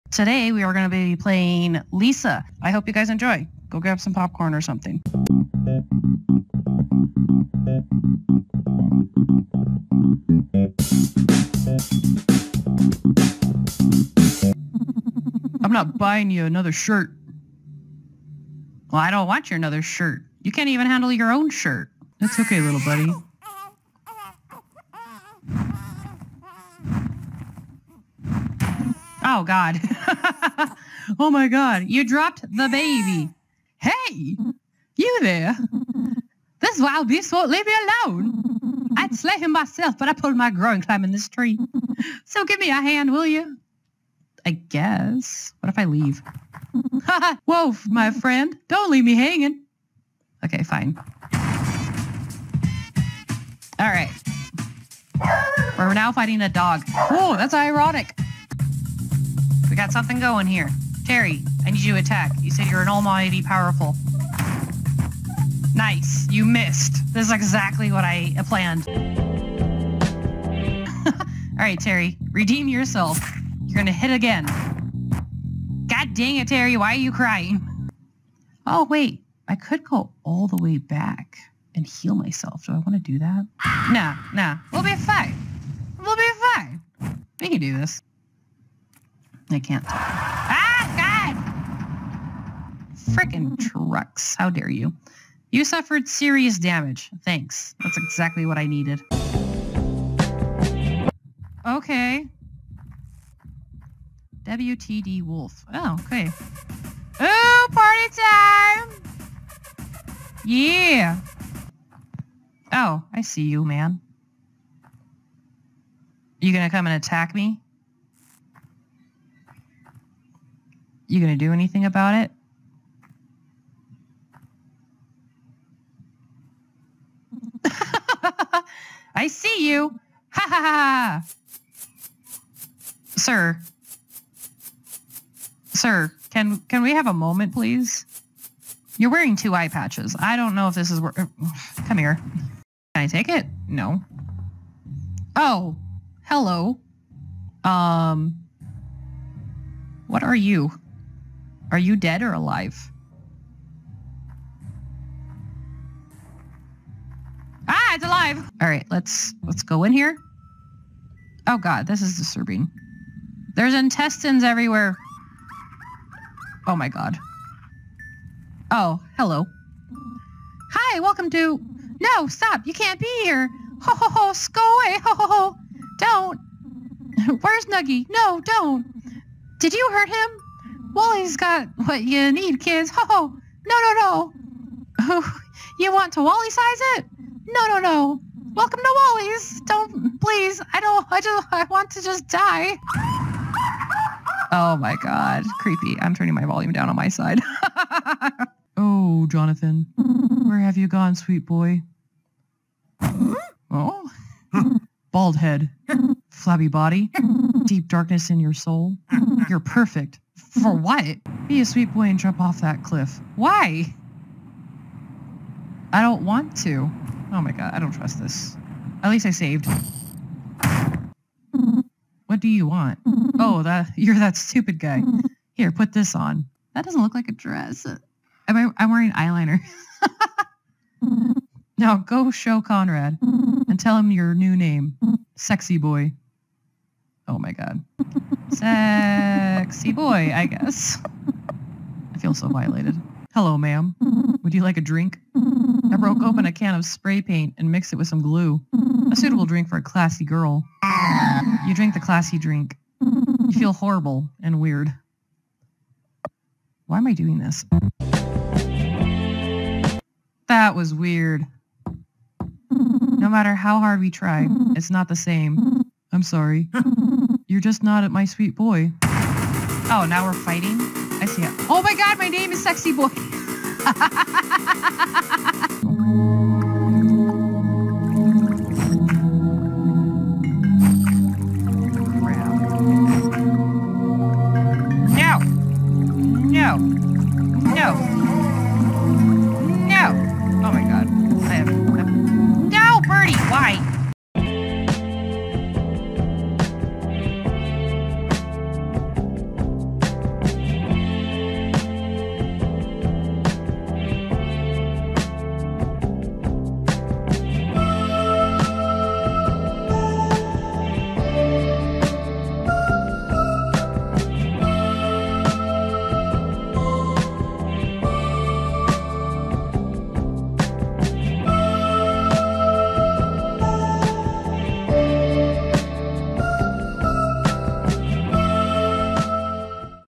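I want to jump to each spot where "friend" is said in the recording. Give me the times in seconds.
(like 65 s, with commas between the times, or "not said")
48 s.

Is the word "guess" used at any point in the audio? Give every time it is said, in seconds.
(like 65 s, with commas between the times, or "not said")
44 s, 240 s.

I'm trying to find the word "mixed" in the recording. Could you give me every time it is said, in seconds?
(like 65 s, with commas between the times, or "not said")
247 s.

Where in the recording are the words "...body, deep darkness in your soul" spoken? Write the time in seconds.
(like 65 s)
206 s.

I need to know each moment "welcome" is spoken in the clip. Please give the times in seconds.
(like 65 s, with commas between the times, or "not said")
170 s, 188 s.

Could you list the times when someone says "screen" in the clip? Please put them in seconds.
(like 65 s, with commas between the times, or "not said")
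not said.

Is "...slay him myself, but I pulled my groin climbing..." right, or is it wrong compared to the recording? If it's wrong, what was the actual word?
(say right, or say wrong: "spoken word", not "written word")
right.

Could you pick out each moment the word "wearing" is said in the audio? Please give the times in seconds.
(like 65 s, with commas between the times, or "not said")
139 s, 228 s.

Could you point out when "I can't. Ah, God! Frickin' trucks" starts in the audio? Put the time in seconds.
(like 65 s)
89 s.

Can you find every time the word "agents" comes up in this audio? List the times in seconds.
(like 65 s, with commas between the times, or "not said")
not said.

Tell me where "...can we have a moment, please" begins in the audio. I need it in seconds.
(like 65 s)
136 s.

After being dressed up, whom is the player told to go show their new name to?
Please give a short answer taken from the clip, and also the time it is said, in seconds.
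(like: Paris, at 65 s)
Conrad, at 232 s.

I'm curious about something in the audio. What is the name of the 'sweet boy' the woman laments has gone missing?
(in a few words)
Jonathan.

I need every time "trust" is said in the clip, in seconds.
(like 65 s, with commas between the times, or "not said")
217 s.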